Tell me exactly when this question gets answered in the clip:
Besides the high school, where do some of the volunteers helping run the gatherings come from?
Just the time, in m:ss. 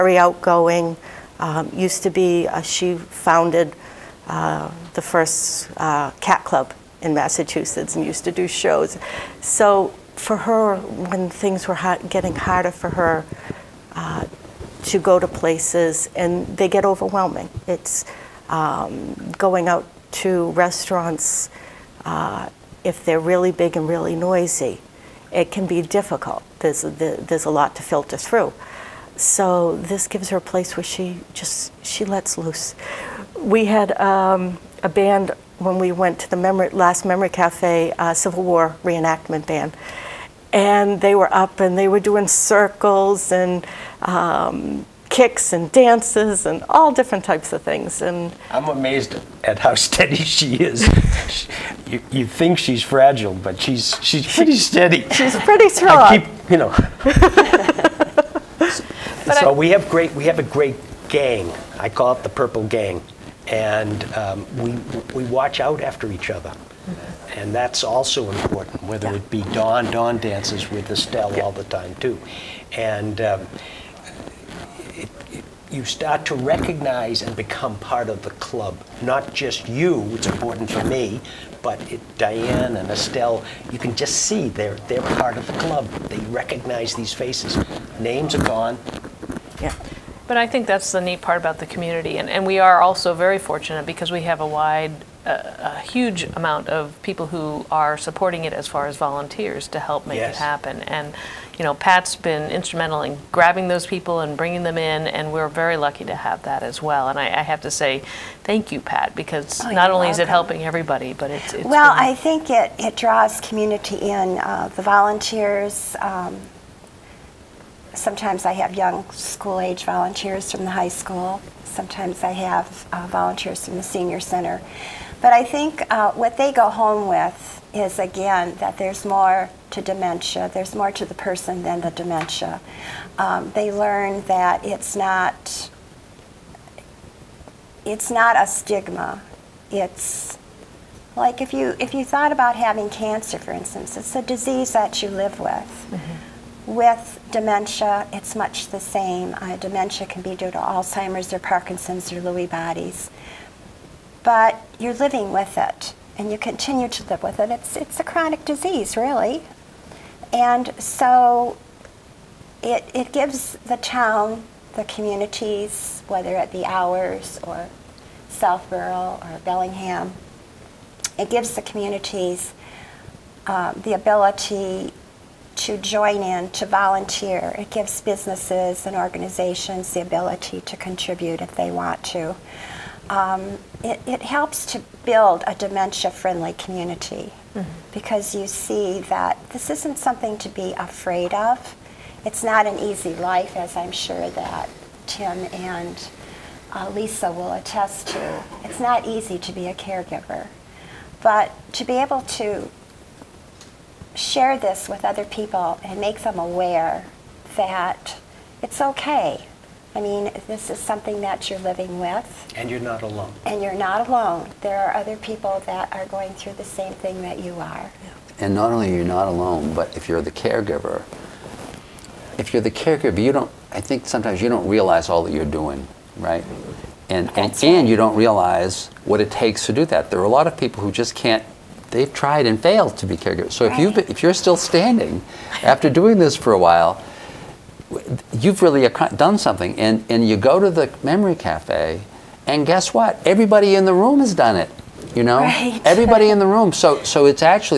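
2:03.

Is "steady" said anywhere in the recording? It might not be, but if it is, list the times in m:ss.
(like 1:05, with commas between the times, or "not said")
0:49, 0:54.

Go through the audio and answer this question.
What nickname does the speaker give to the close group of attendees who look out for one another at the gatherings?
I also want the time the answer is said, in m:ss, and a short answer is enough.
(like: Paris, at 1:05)
Purple Gang, at 1:02.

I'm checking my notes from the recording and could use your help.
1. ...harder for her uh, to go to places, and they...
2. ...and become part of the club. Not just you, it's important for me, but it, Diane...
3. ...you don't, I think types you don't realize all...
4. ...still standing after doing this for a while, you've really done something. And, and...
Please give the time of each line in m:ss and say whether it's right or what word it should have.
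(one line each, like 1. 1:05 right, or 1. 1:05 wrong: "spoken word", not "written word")
1. 0:12 right
2. 1:17 right
3. 3:43 wrong: "sometimes", not "types"
4. 3:54 right.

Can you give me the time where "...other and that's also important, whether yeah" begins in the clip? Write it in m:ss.
1:06.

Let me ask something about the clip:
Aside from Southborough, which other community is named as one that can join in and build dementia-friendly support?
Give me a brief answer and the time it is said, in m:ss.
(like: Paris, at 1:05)
Bellingham, at 2:49.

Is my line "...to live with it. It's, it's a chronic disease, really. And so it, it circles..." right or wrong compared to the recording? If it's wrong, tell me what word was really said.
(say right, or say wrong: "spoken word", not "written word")
wrong: "gives", not "circles".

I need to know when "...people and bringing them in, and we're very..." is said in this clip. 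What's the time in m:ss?
1:43.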